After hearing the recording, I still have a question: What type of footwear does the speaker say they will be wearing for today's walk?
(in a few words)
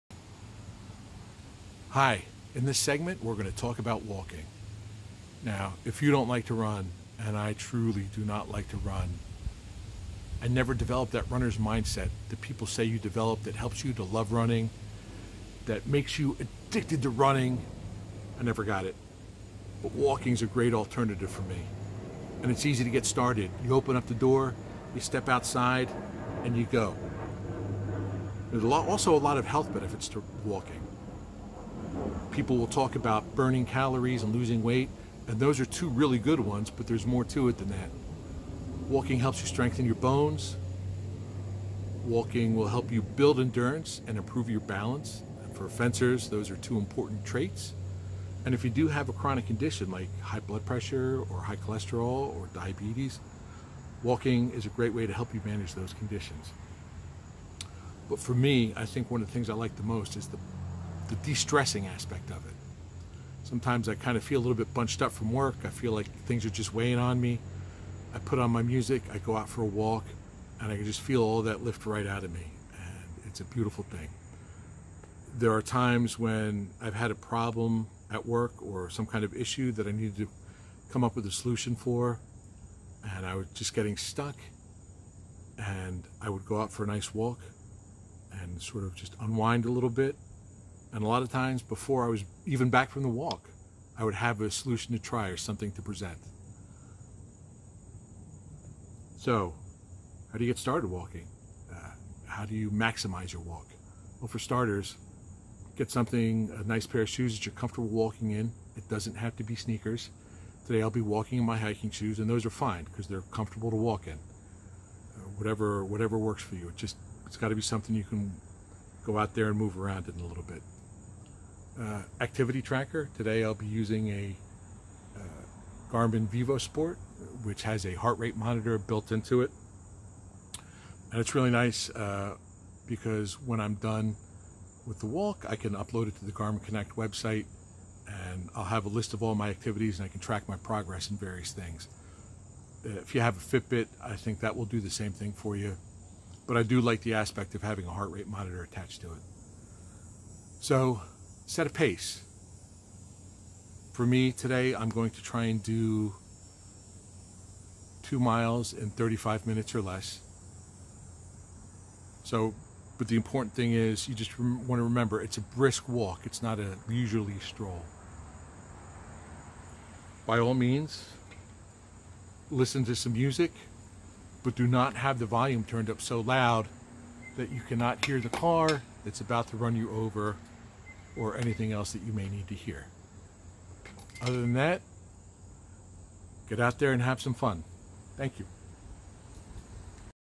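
Hiking shoes.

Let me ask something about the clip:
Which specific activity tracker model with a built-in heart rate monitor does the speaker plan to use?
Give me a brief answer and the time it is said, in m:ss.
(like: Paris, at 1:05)
Garmin VivoSport, at 2:05.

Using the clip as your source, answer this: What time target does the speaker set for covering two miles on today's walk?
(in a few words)
35 minutes or less.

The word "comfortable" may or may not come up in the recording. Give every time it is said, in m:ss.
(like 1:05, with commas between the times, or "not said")
1:47, 1:53.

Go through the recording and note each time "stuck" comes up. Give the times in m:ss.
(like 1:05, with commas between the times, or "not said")
1:23.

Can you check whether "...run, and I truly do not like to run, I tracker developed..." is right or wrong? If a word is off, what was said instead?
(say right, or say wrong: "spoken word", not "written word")
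wrong: "never", not "tracker".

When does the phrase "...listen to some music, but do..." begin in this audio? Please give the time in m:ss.
2:52.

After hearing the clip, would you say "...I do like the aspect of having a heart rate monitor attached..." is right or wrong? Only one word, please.
right.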